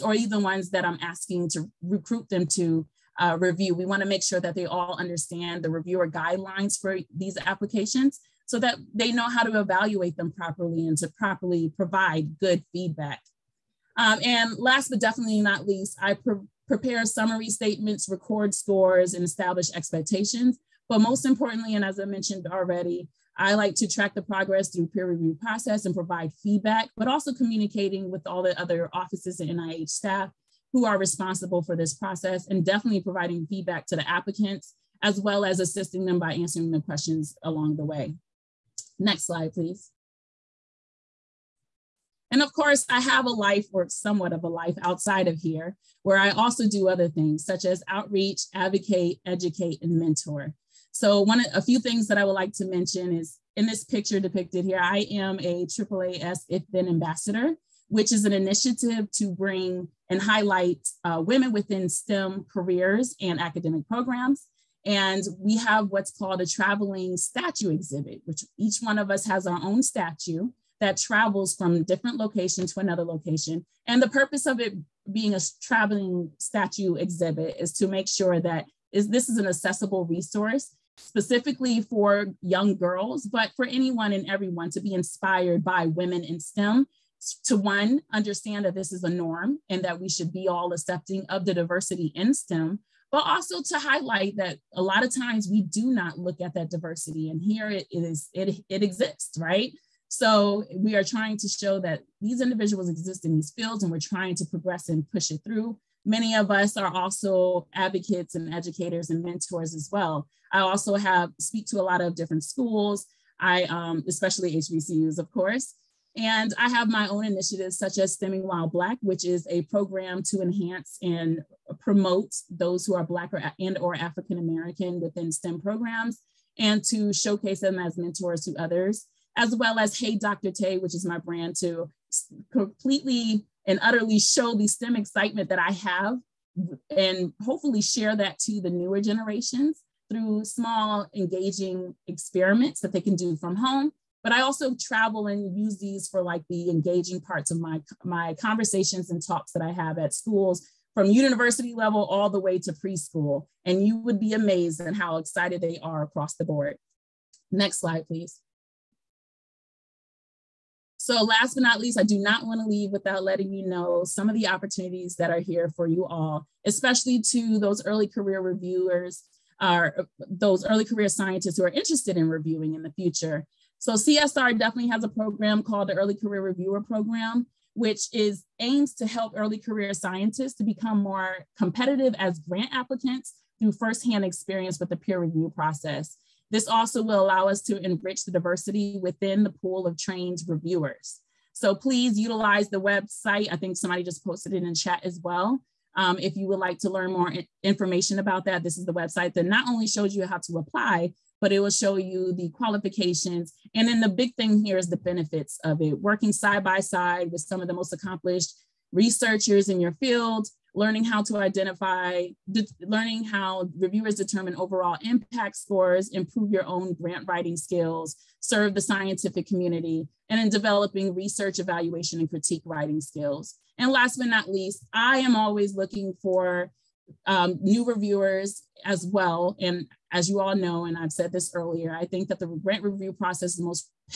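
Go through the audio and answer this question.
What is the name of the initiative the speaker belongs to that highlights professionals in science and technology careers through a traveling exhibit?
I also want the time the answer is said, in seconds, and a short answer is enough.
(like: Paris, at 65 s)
AAAS If Then Ambassador, at 55 s.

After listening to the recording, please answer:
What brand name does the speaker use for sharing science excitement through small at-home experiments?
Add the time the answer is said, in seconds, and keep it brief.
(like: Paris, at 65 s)
Hey Dr. Tay, at 129 s.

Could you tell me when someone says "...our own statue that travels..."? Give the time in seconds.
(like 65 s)
69 s.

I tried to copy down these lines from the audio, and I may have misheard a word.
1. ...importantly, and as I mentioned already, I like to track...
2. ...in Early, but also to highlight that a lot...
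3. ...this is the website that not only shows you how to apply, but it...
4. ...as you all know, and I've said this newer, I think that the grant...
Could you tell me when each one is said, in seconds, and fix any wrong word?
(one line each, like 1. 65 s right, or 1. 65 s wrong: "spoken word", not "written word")
1. 21 s right
2. 92 s wrong: "STEM", not "Early"
3. 198 s right
4. 230 s wrong: "earlier", not "newer".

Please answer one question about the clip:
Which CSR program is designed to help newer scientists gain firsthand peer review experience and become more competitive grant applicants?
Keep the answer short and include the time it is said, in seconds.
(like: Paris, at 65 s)
Early Career Reviewer Program, at 175 s.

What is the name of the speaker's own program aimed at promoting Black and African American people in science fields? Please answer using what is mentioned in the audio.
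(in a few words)
Stemming While Black.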